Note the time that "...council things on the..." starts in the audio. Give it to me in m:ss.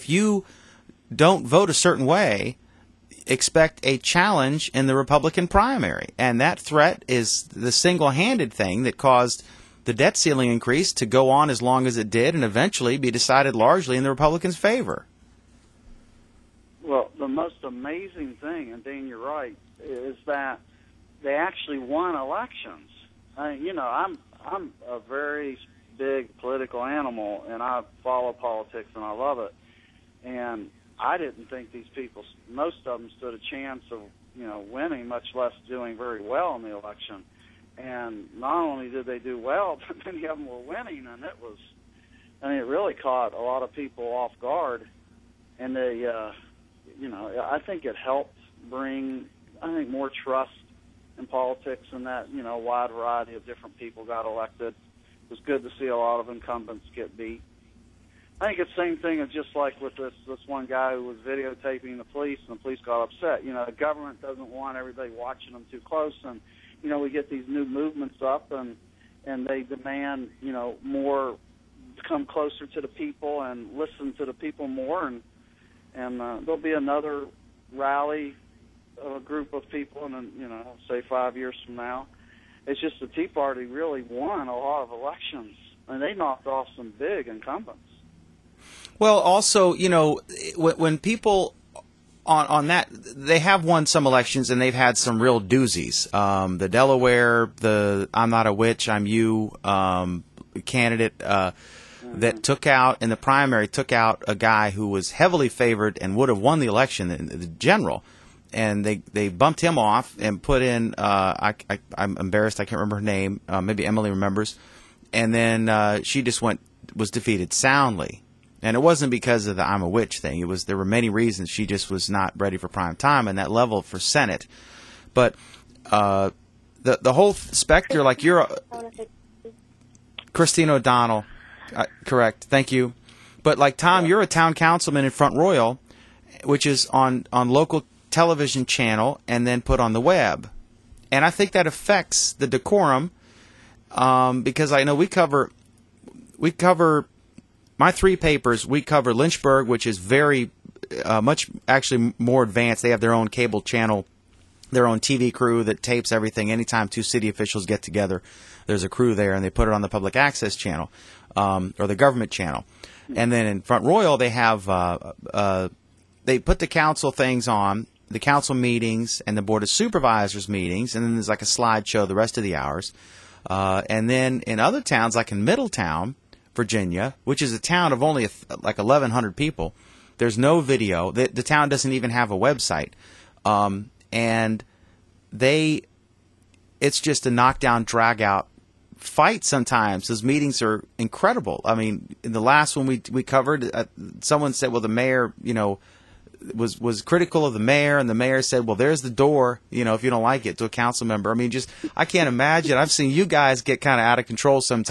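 2:46.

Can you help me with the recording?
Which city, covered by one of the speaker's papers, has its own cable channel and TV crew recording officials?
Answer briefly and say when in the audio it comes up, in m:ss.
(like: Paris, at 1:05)
Lynchburg, at 2:29.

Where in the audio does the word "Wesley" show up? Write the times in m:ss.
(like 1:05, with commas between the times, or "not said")
not said.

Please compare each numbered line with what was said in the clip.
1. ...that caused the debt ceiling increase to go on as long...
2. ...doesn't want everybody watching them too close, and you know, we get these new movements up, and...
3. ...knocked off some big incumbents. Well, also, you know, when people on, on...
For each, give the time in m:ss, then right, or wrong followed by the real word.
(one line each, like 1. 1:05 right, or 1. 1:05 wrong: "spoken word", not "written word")
1. 0:08 right
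2. 1:04 right
3. 1:26 right.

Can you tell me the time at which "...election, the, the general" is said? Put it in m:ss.
1:46.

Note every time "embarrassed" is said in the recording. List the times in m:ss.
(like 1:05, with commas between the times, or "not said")
1:52.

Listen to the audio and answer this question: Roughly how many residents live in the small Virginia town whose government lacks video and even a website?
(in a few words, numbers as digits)
1,100.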